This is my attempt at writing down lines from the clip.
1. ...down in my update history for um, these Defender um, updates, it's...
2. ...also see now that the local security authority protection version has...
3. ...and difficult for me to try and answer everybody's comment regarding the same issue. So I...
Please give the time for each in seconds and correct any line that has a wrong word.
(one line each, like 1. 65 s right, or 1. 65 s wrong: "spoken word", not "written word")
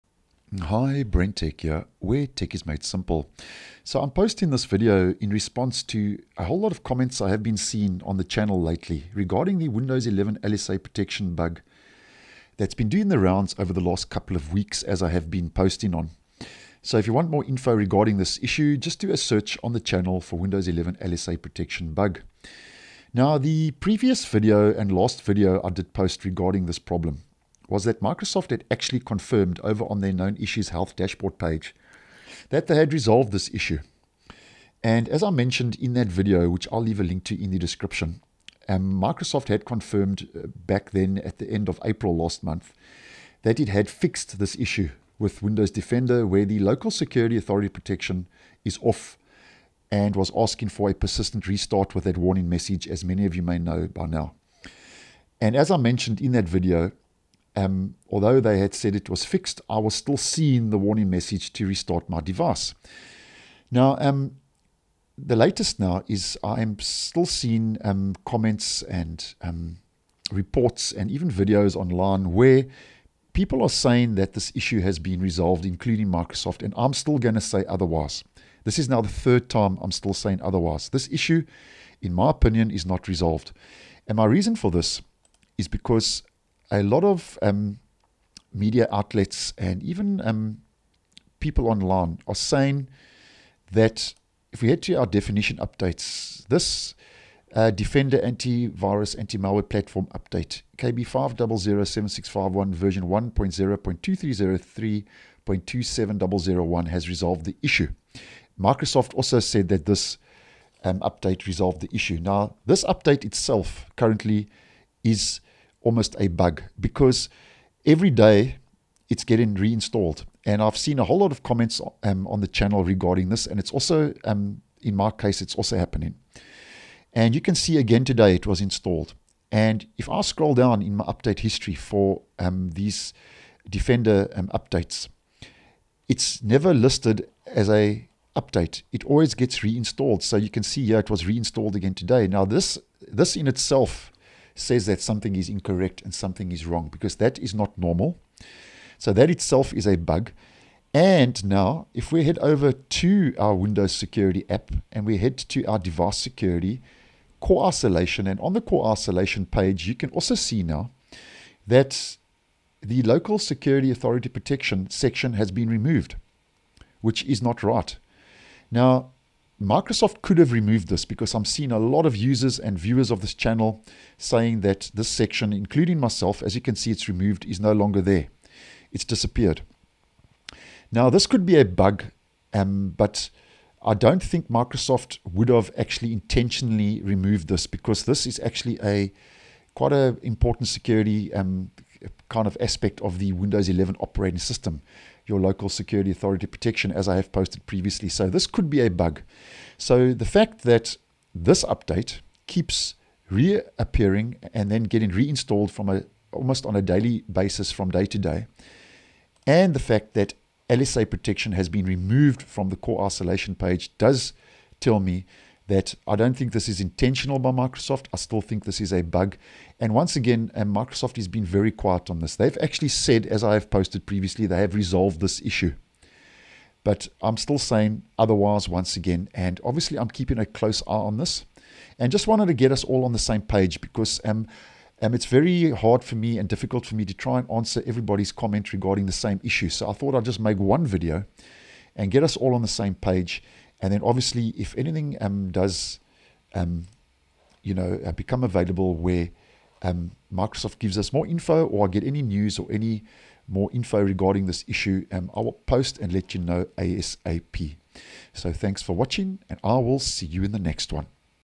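1. 130 s right
2. 160 s wrong: "section", not "version"
3. 236 s right.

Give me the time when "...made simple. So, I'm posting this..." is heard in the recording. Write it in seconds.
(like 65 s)
2 s.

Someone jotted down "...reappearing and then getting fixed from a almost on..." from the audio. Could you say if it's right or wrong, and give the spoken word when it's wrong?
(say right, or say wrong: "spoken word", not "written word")
wrong: "reinstalled", not "fixed".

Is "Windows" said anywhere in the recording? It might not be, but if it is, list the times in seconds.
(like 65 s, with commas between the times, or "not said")
9 s, 20 s, 45 s, 153 s, 193 s.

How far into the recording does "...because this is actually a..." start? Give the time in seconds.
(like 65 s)
187 s.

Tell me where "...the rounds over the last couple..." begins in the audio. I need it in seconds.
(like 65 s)
13 s.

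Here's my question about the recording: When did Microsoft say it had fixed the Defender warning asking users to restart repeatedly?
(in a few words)
End of April.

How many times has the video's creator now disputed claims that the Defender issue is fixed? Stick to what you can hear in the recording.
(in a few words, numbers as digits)
Third time.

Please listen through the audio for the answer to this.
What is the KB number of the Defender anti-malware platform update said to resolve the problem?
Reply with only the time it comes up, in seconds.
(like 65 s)
100 s.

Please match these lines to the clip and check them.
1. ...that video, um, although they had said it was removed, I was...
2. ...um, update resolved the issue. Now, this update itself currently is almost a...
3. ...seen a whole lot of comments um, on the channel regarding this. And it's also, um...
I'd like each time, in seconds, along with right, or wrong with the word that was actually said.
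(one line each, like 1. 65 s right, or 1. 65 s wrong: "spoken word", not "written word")
1. 56 s wrong: "fixed", not "removed"
2. 110 s right
3. 120 s right.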